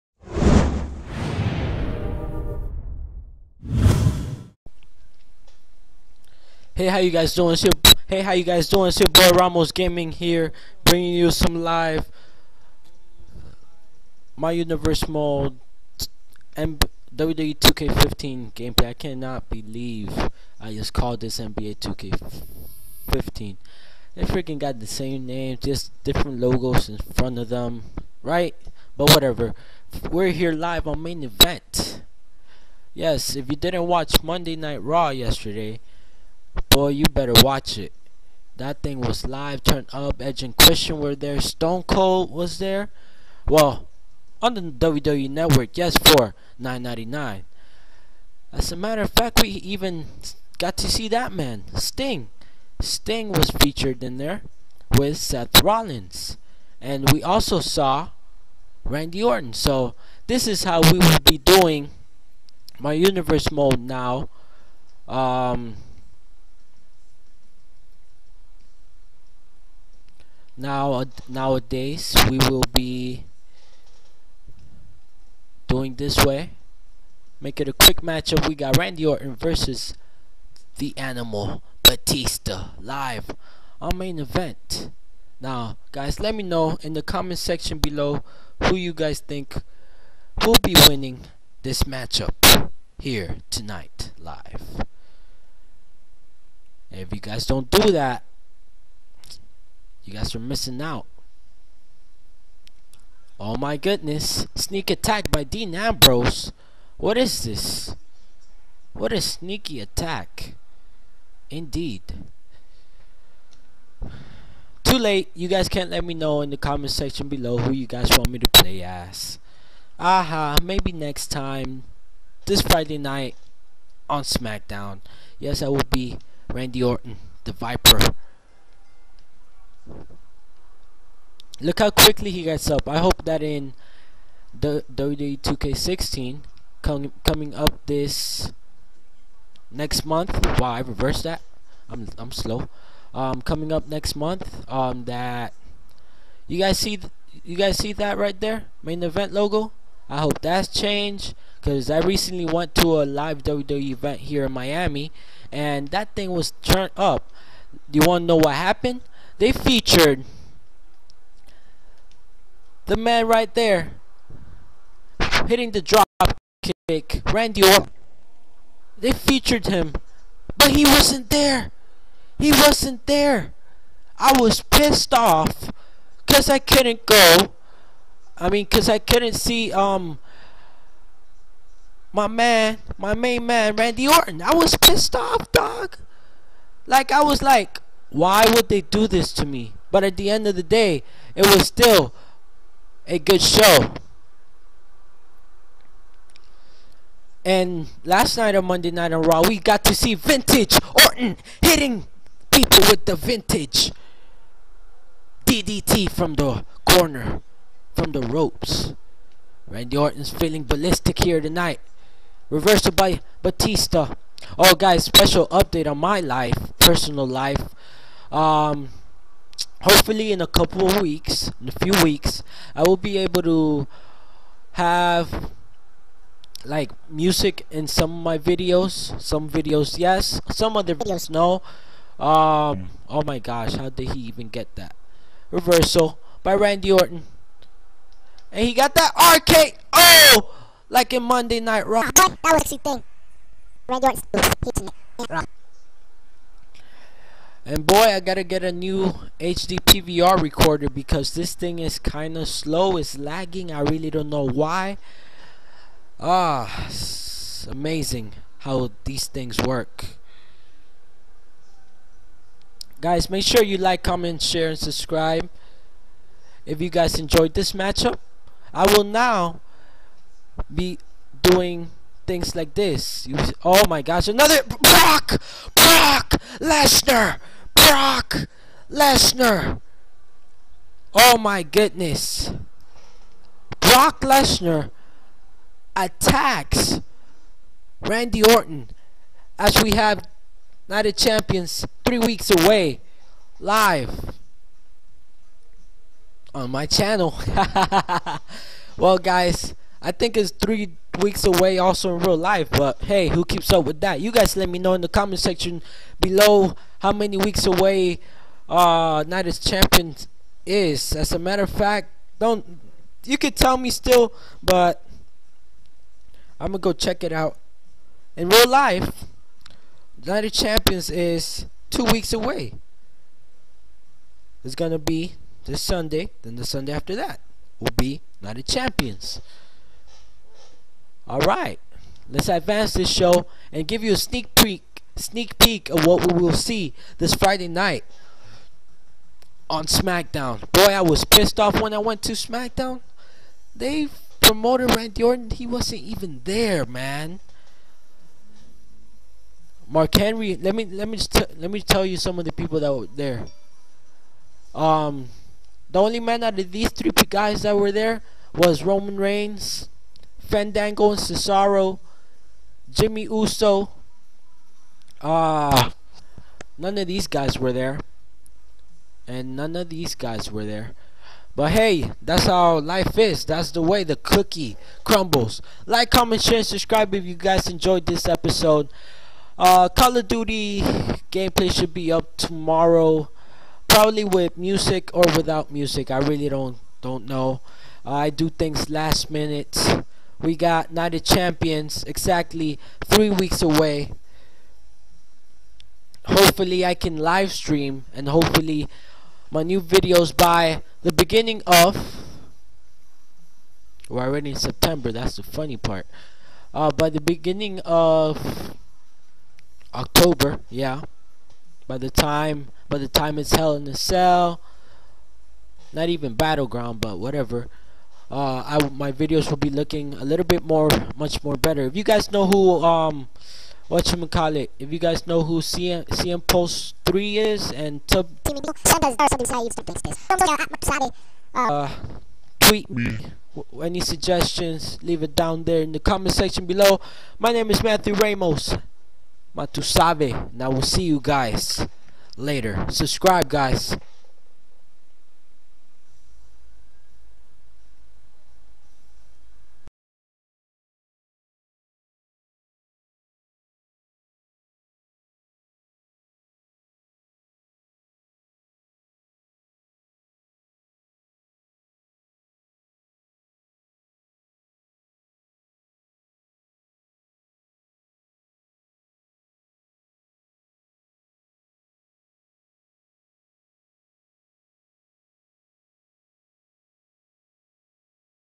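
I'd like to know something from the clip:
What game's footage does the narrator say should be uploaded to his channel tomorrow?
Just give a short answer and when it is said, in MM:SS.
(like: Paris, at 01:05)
Call of Duty, at 06:19.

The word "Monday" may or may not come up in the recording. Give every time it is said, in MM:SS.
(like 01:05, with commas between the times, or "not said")
00:34, 03:18, 04:01.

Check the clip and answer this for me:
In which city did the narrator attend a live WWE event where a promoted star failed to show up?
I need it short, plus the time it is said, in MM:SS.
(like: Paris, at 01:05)
Miami, at 02:34.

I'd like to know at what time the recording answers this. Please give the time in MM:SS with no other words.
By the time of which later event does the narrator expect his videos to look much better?
06:53.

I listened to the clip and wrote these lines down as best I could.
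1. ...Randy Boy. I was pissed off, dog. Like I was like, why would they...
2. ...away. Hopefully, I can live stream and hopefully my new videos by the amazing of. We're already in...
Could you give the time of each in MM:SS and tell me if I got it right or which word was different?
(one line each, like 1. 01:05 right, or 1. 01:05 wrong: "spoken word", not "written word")
1. 03:03 wrong: "Orton", not "Boy"
2. 06:33 wrong: "beginning", not "amazing".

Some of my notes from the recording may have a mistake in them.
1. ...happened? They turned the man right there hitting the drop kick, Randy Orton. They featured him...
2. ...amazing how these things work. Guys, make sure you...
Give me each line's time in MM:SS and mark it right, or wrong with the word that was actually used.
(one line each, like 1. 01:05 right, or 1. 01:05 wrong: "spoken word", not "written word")
1. 02:38 wrong: "featured", not "turned"
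2. 04:17 right.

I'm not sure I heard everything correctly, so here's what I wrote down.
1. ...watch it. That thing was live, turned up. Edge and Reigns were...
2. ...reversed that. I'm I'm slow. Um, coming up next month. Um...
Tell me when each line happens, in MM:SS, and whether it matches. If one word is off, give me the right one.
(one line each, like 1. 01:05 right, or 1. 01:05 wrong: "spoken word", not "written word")
1. 00:37 wrong: "Christian", not "Reigns"
2. 02:20 right.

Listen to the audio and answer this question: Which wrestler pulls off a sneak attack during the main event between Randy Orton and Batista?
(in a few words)
Dean Ambrose.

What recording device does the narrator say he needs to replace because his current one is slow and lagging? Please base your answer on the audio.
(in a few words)
HD PVR recorder.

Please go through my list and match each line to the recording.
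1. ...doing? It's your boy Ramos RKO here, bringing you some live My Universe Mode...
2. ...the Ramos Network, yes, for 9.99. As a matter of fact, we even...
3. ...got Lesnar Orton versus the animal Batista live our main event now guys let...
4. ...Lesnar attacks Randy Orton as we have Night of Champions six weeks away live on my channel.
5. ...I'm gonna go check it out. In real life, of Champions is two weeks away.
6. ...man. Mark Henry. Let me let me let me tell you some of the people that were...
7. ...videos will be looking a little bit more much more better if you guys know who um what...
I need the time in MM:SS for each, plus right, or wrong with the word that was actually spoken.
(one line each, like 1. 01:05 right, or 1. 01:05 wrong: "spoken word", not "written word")
1. 00:08 wrong: "Gaming", not "RKO"
2. 00:44 wrong: "WWE", not "Ramos"
3. 01:18 wrong: "Randy", not "Lesnar"
4. 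04:44 wrong: "three", not "six"
5. 05:16 right
6. 05:46 right
7. 06:59 right.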